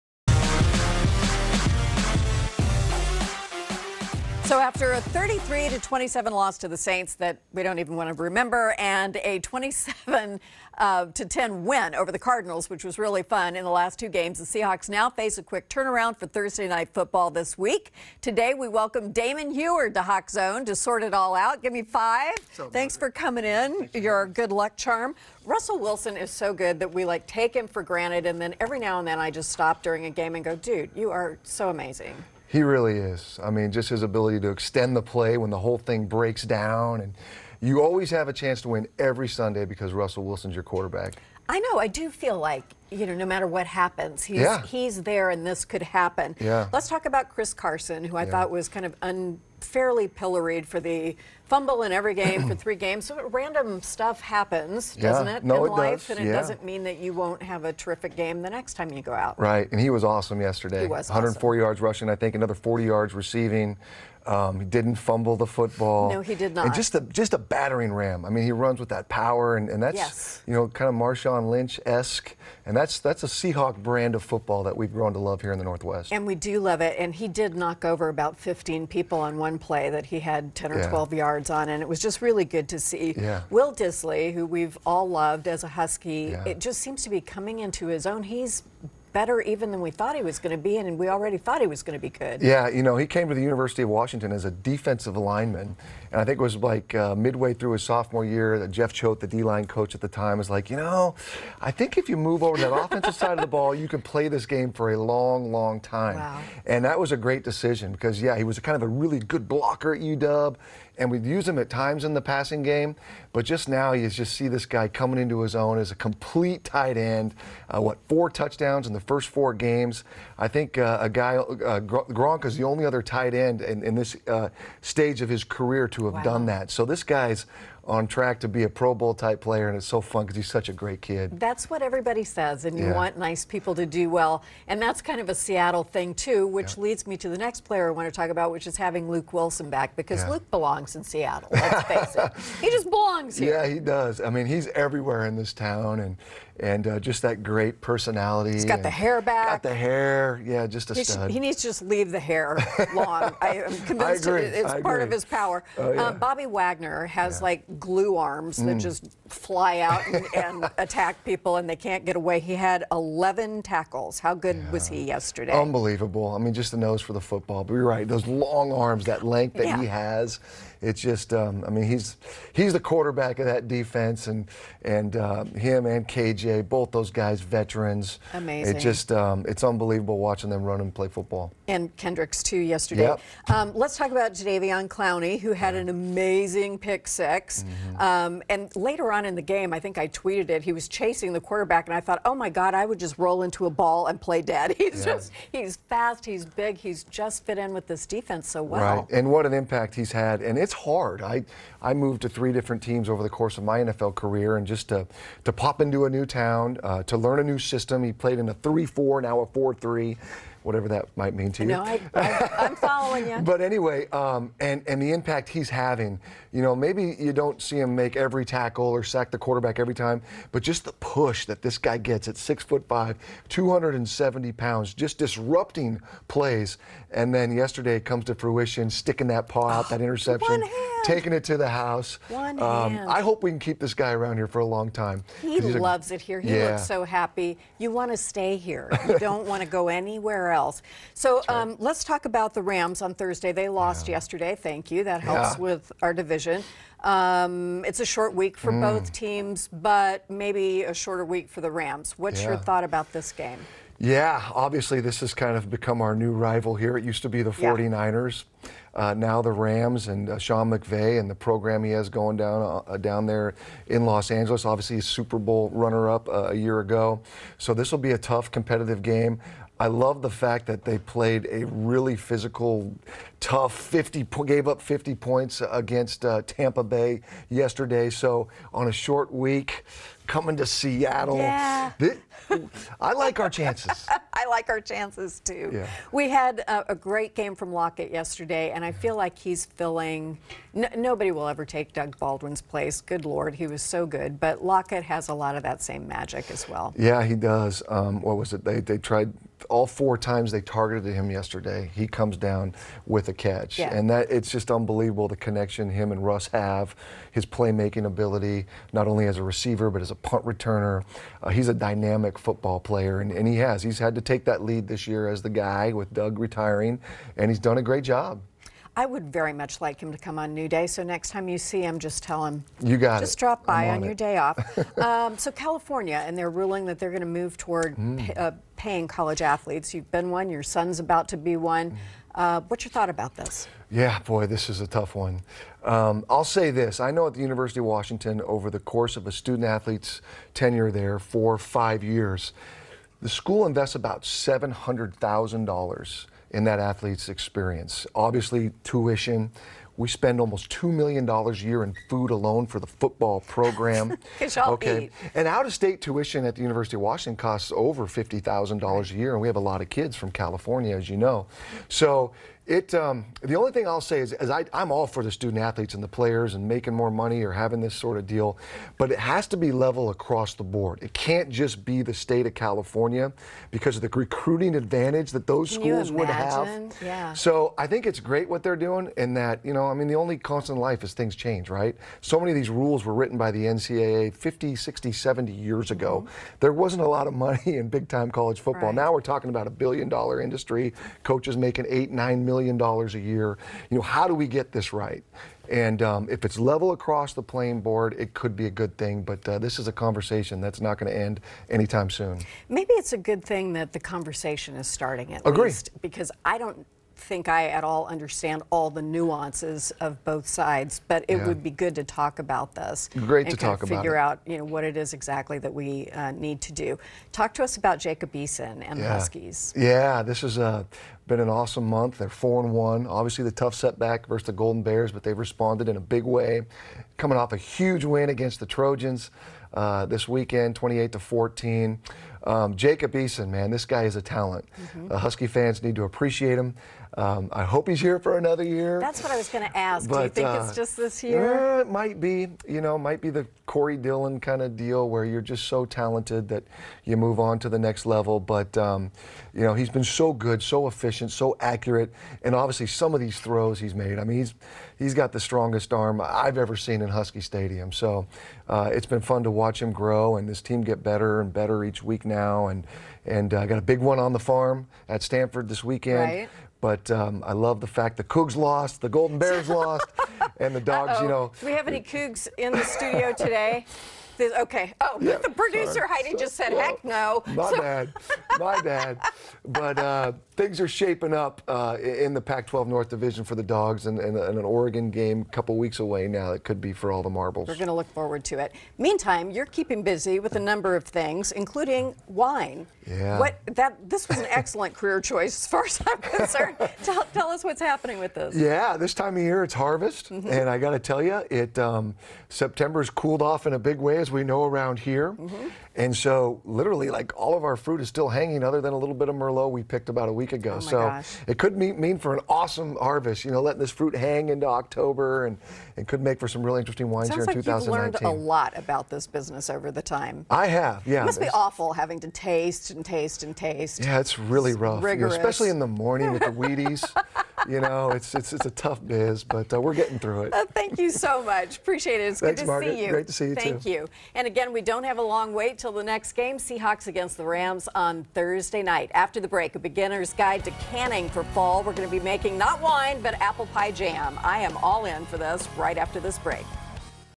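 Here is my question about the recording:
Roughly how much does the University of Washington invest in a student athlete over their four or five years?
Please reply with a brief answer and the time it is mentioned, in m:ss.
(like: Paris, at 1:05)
$700,000, at 5:44.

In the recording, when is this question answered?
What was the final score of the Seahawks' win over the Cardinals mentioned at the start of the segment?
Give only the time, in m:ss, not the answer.
0:09.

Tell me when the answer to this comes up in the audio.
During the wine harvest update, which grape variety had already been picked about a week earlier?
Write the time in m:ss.
8:29.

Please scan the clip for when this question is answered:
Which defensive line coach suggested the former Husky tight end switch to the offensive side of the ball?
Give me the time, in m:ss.
1:38.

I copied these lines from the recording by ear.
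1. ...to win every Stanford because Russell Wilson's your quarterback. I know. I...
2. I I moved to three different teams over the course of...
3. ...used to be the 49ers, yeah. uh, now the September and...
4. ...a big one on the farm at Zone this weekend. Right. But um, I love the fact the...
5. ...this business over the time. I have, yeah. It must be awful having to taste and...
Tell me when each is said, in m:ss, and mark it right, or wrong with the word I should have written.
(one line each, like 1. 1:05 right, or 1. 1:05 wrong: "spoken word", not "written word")
1. 0:38 wrong: "Sunday", not "Stanford"
2. 3:21 right
3. 4:17 wrong: "Rams", not "September"
4. 7:43 wrong: "Stanford", not "Zone"
5. 8:39 right.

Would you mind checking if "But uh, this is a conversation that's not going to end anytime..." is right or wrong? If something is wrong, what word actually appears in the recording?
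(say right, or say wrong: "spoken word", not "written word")
right.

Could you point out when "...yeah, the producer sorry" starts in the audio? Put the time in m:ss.
7:55.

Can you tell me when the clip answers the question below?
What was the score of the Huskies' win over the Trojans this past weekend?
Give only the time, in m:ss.
7:10.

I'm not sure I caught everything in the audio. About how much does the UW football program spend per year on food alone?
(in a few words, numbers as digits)
$2 million.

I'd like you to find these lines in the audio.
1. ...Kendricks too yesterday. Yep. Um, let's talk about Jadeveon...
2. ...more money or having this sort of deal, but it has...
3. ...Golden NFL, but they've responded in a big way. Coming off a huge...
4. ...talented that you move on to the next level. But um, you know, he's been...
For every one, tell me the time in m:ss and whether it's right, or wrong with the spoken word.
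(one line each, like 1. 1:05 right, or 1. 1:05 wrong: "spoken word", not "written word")
1. 3:01 right
2. 6:06 right
3. 7:04 wrong: "Bears", not "NFL"
4. 7:25 right.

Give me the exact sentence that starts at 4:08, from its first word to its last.
both teams, but maybe a shorter week for the Rams.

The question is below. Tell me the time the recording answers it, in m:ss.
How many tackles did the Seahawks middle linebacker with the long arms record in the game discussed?
2:42.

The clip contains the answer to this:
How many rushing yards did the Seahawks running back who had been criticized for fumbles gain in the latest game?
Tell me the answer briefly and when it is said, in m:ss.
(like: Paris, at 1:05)
104, at 1:01.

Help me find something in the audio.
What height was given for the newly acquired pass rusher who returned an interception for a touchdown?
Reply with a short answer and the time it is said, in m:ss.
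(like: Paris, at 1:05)
6 foot 5, at 3:42.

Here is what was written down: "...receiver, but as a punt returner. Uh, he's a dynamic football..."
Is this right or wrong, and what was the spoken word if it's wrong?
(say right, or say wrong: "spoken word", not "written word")
right.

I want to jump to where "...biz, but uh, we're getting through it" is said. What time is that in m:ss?
8:49.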